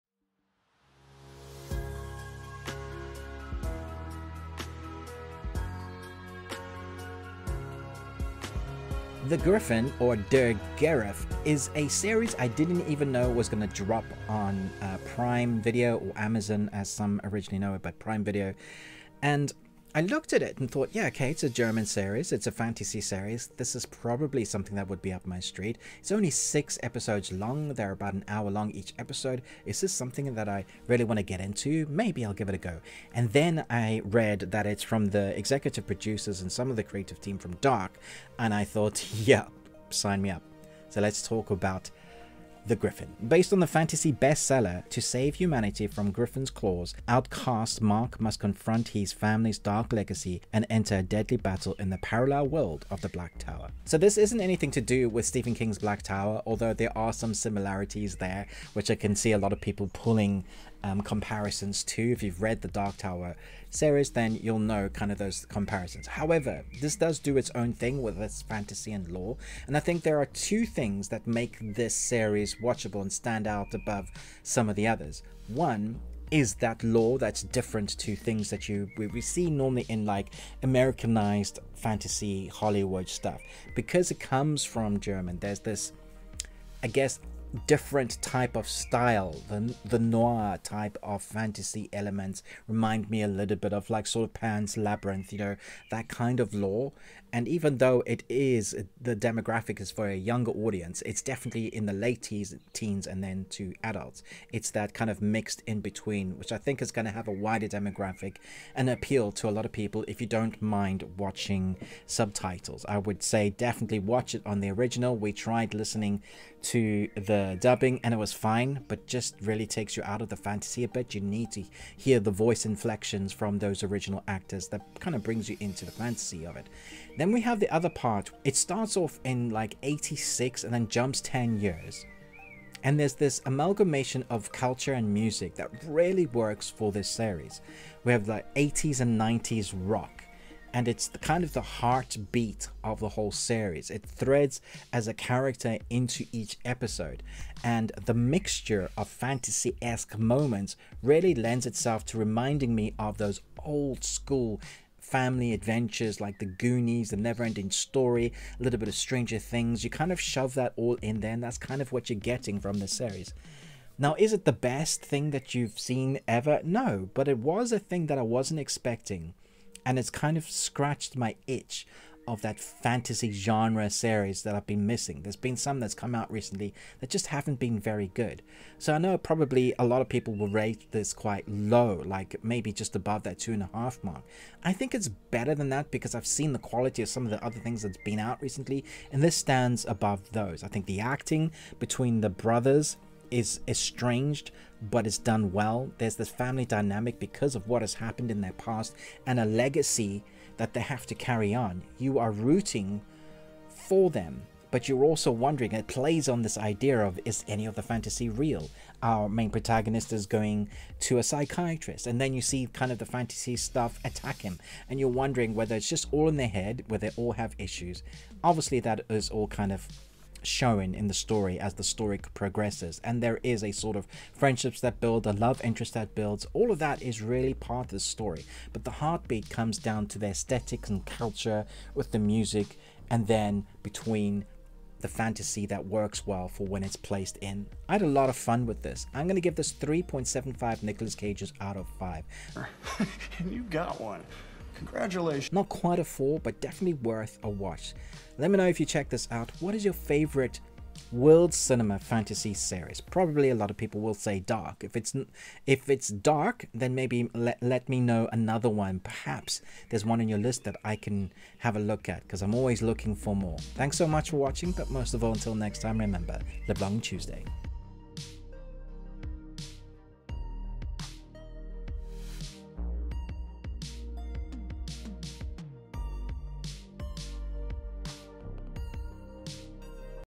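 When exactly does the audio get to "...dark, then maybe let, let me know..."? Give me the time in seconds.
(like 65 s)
256 s.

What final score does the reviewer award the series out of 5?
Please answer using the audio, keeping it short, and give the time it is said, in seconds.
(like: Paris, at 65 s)
3.75, at 239 s.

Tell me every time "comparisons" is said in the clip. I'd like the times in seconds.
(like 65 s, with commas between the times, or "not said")
61 s, 65 s.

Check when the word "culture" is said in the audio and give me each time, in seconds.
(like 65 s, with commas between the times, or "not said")
134 s, 231 s.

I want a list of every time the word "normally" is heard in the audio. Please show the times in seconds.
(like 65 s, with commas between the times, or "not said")
79 s.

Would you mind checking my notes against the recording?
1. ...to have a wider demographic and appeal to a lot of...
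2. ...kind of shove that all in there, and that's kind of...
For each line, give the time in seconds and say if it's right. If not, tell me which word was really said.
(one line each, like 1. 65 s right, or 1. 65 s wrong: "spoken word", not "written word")
1. 107 s right
2. 159 s right.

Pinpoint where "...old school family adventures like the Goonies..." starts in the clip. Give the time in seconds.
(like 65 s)
153 s.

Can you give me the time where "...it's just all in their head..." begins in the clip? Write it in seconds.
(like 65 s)
215 s.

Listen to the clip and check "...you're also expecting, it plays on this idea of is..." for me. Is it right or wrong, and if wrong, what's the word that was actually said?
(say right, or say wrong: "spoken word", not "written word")
wrong: "wondering", not "expecting".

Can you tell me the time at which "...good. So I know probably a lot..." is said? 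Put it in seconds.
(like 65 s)
178 s.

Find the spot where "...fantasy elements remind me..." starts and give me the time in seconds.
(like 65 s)
91 s.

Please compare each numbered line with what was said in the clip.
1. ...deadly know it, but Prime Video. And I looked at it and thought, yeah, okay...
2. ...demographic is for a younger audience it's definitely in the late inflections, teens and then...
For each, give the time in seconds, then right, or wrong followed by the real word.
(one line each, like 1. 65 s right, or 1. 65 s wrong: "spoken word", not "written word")
1. 17 s wrong: "originally", not "deadly"
2. 99 s wrong: "teens", not "inflections".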